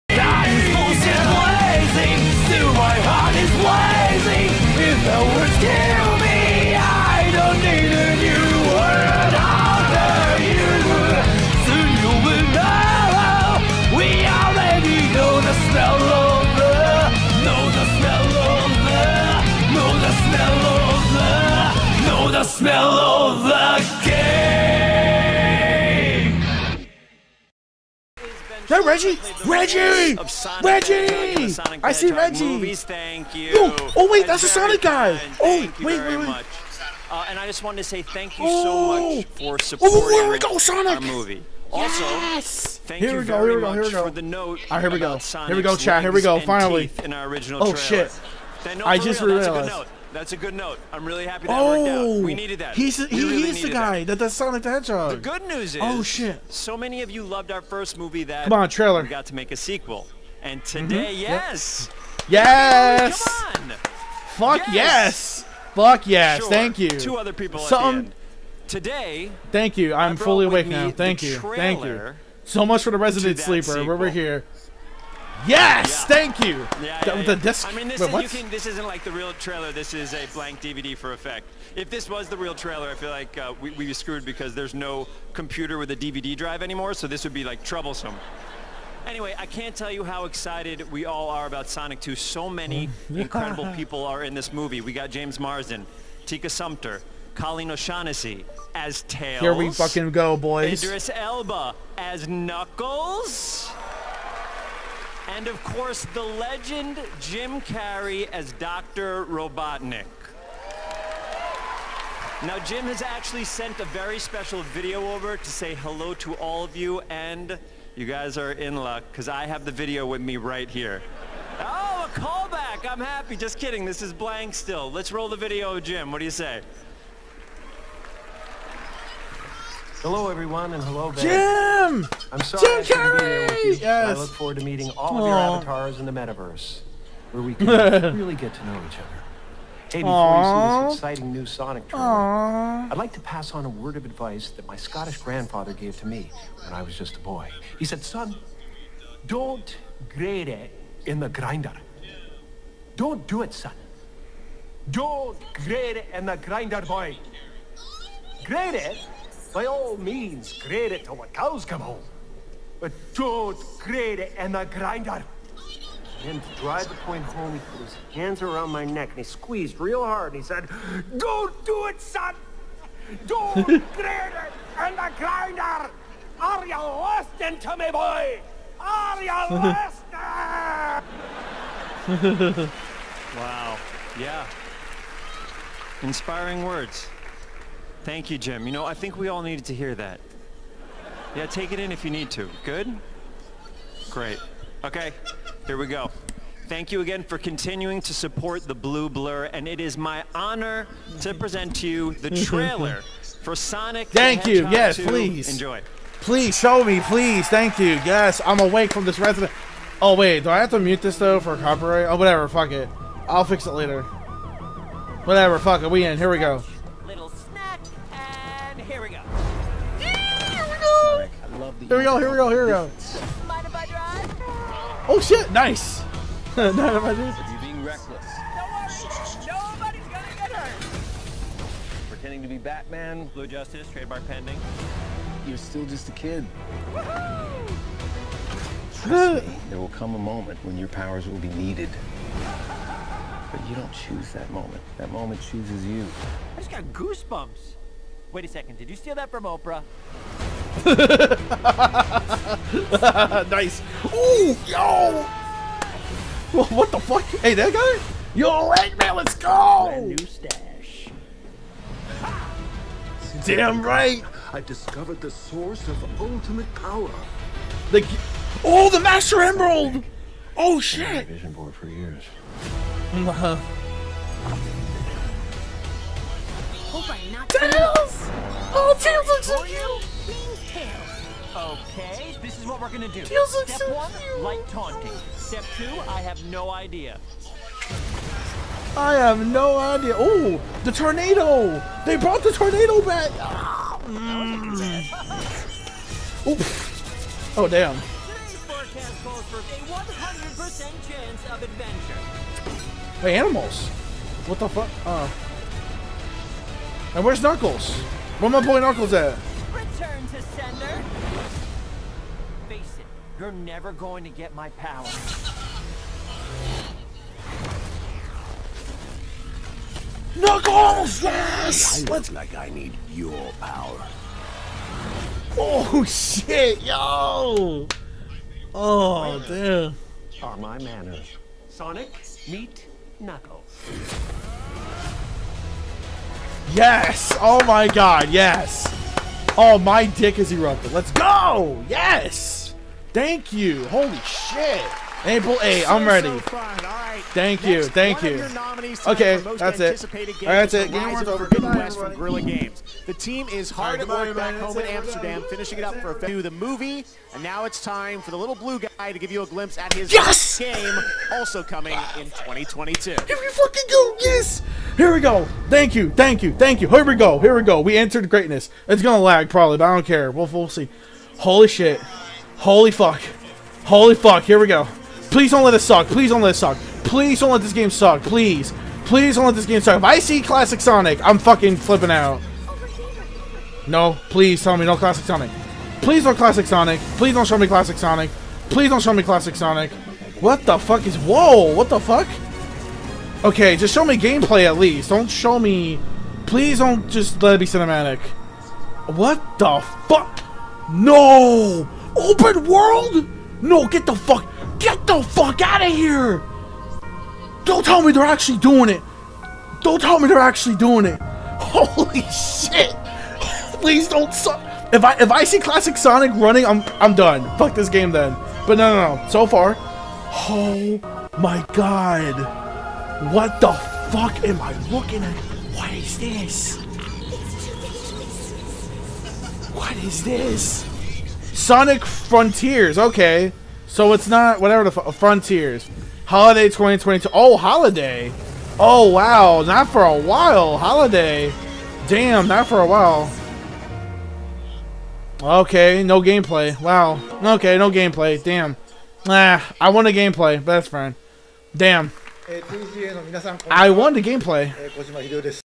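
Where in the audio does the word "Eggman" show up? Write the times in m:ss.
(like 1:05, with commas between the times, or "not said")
4:18.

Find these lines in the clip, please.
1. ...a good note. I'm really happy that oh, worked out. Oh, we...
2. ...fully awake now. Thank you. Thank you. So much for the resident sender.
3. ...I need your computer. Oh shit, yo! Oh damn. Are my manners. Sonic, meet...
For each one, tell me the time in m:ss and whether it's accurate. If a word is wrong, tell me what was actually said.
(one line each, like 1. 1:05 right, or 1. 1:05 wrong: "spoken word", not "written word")
1. 0:50 right
2. 1:10 wrong: "sleeper", not "sender"
3. 5:22 wrong: "power", not "computer".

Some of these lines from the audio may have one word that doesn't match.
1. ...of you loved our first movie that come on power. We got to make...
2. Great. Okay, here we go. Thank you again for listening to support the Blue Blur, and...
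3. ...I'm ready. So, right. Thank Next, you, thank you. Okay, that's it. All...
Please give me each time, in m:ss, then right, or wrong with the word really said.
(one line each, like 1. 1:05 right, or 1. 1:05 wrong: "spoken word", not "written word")
1. 0:57 wrong: "trailer", not "power"
2. 3:14 wrong: "continuing", not "listening"
3. 5:45 right.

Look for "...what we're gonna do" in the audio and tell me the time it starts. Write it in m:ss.
4:42.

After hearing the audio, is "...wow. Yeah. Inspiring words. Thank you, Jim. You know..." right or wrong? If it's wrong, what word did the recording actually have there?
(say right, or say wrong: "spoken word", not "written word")
right.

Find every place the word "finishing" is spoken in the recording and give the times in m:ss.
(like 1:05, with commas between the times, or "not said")
5:55.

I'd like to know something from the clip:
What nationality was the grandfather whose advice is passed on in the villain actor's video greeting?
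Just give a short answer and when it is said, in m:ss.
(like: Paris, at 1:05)
Scottish, at 2:24.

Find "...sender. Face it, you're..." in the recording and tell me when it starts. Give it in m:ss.
5:10.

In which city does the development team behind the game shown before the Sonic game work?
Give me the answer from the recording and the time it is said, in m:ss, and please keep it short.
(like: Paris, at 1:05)
Amsterdam, at 5:54.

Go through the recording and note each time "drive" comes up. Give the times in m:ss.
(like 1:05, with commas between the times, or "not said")
1:26, 2:46.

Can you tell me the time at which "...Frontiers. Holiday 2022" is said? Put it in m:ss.
7:15.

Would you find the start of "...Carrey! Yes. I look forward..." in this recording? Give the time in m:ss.
2:12.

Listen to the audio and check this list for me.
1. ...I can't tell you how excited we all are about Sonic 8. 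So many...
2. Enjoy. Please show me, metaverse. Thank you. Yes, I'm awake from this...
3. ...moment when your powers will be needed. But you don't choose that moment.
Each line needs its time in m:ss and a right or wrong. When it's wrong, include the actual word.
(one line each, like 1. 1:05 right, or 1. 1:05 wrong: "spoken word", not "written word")
1. 1:29 wrong: "2", not "8"
2. 3:25 wrong: "please", not "metaverse"
3. 4:00 right.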